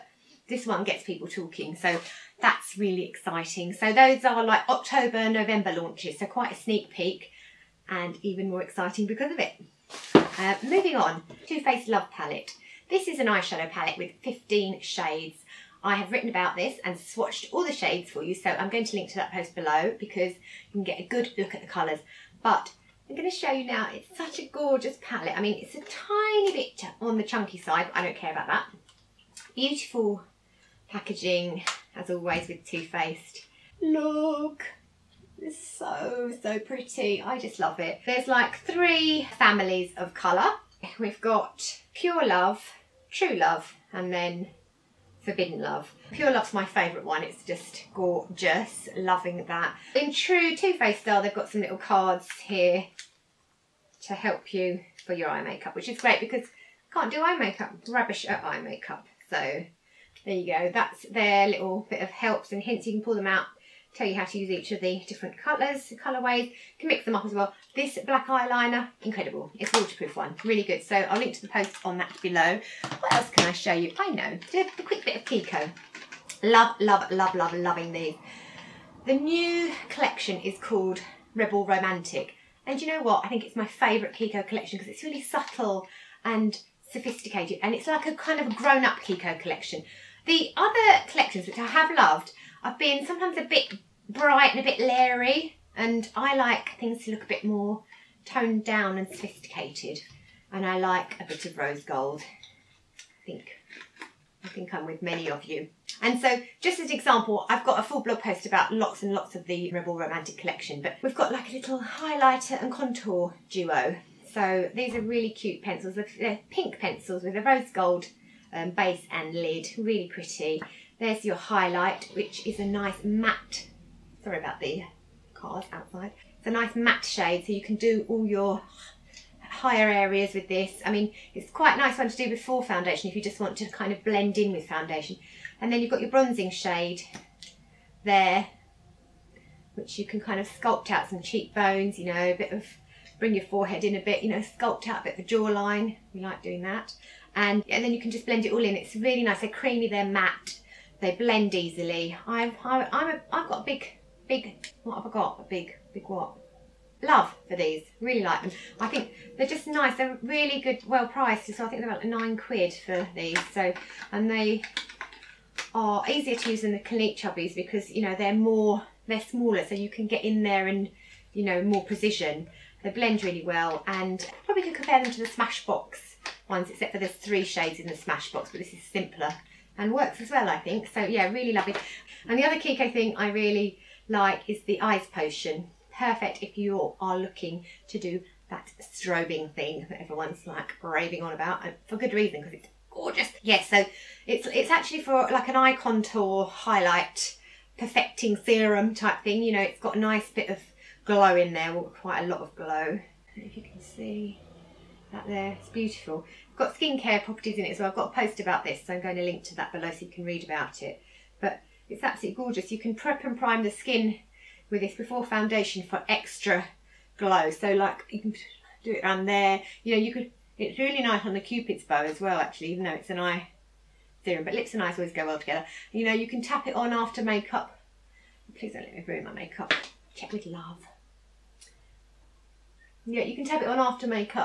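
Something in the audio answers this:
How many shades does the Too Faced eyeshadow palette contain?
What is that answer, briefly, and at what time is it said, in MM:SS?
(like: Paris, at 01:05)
15, at 00:14.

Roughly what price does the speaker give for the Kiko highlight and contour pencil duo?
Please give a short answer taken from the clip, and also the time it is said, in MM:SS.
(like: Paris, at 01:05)
About nine quid, at 02:41.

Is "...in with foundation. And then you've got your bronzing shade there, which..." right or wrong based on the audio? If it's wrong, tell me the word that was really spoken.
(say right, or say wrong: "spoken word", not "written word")
right.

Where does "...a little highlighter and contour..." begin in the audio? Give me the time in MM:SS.
01:51.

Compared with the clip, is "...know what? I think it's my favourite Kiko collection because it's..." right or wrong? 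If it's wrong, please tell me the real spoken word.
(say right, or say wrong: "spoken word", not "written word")
right.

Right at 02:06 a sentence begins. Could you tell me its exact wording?
It's a nice matte shade, so you can do all your higher areas with this.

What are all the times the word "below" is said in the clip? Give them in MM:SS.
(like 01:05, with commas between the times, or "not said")
00:19, 01:12, 03:29.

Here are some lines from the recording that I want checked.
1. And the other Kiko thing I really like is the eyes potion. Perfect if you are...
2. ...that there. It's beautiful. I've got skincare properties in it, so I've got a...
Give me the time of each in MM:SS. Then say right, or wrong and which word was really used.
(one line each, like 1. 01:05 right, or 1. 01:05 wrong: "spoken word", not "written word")
1. 03:02 right
2. 03:25 right.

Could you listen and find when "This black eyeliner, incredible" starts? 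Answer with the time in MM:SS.
01:07.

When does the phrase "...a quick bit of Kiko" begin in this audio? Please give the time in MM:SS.
01:14.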